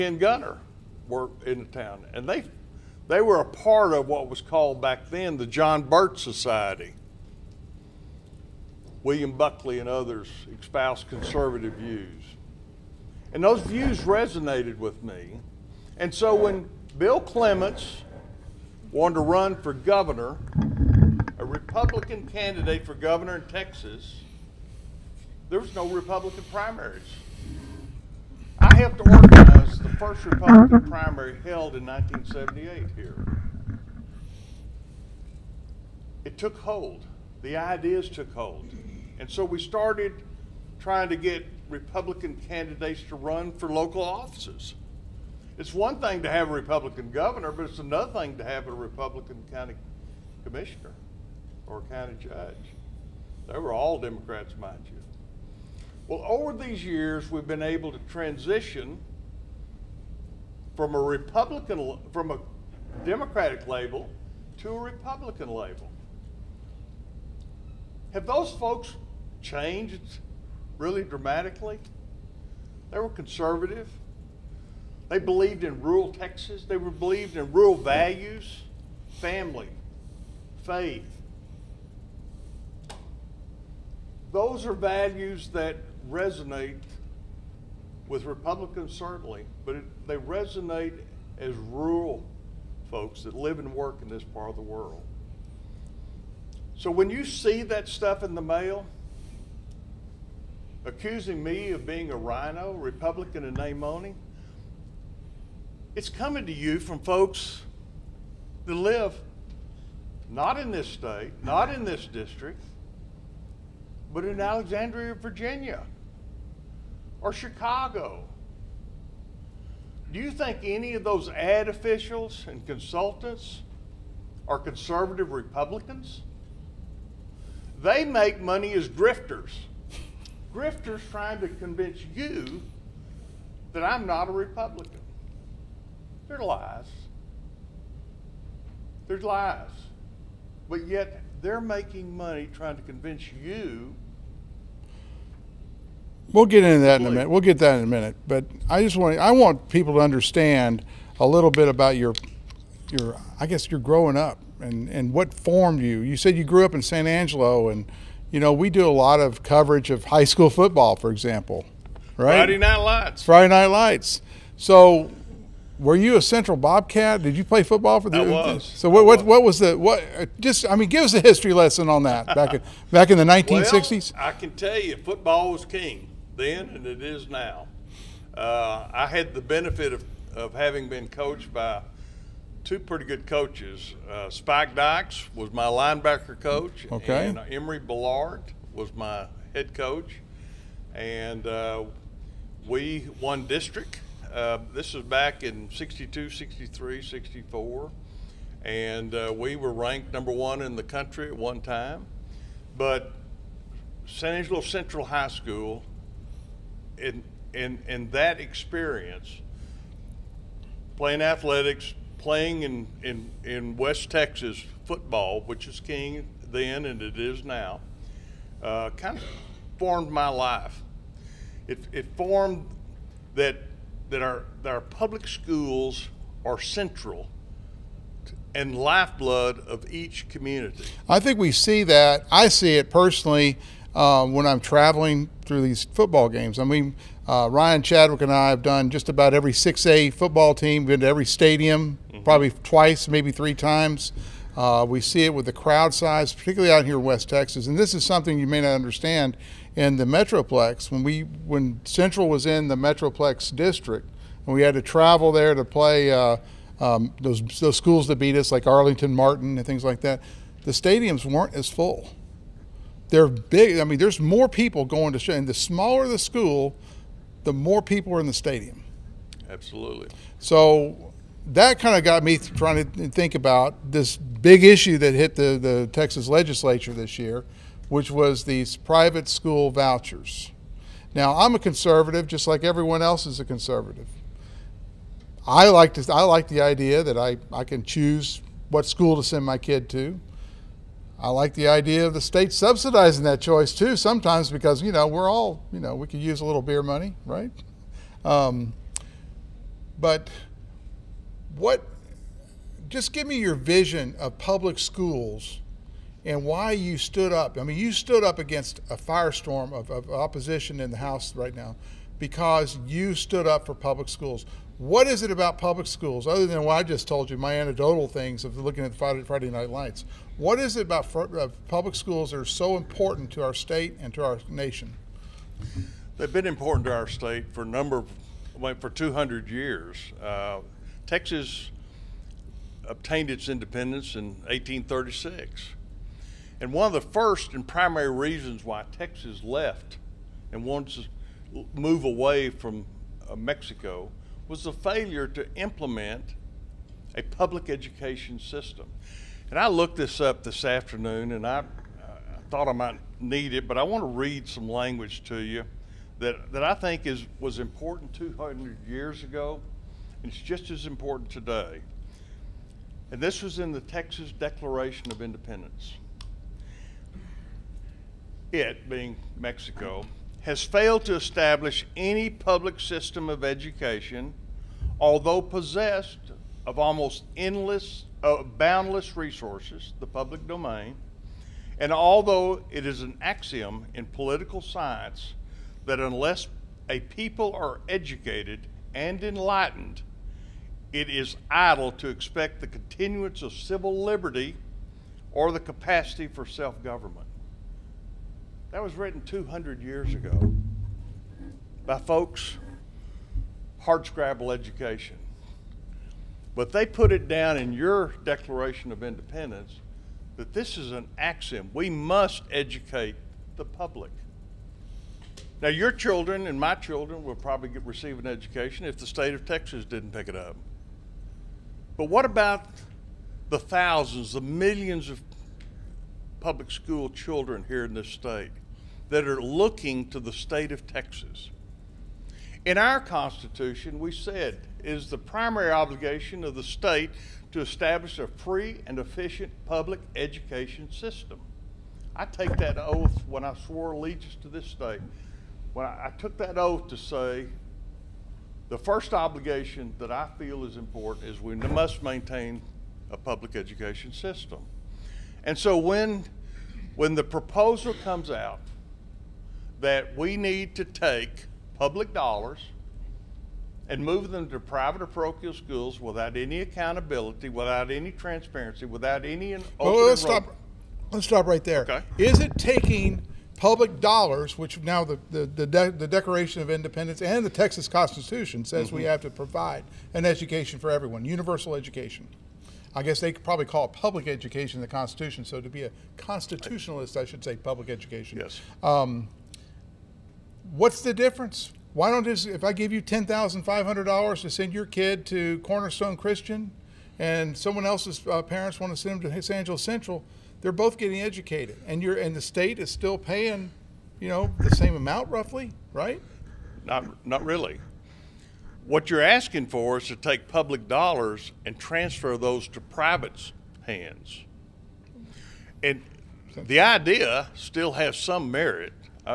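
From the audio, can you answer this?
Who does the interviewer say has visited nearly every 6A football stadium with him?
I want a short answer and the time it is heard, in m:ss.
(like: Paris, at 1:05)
Ryan Chadwick, at 3:57.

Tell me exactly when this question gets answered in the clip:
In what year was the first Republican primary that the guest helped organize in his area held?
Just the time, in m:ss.
0:31.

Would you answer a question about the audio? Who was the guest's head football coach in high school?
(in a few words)
Emory Bellard.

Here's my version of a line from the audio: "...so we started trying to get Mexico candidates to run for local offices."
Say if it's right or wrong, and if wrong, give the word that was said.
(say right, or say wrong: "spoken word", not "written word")
wrong: "Republican", not "Mexico".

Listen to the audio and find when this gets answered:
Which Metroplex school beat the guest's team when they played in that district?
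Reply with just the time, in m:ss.
4:18.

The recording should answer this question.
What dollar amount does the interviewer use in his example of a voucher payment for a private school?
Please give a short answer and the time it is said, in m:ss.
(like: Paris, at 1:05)
$10,500, at 8:13.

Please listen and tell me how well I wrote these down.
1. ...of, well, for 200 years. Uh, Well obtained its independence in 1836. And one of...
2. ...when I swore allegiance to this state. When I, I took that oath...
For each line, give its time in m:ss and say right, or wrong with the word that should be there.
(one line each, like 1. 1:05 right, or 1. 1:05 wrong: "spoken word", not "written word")
1. 5:27 wrong: "Texas", not "Well"
2. 7:23 right.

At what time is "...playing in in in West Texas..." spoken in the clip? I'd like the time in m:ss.
3:32.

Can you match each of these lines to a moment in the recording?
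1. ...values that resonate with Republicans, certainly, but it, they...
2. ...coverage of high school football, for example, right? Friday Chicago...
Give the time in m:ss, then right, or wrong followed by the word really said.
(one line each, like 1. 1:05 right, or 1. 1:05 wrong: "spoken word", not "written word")
1. 1:24 right
2. 2:39 wrong: "Night", not "Chicago".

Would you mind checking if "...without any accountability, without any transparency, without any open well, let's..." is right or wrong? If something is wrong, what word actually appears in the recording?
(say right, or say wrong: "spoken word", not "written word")
right.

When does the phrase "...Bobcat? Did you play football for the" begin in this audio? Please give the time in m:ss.
2:46.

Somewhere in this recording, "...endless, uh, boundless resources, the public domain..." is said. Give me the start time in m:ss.
6:17.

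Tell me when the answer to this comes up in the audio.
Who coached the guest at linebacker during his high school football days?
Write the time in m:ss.
3:04.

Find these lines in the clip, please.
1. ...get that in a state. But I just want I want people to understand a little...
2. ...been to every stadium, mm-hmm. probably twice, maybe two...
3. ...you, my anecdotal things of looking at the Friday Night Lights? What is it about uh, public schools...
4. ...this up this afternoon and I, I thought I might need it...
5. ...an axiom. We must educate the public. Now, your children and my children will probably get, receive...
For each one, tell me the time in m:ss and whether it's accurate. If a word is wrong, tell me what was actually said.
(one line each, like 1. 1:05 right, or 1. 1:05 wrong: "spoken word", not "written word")
1. 2:27 wrong: "minute", not "state"
2. 4:00 wrong: "three", not "two"
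3. 5:17 right
4. 5:49 right
5. 6:50 right.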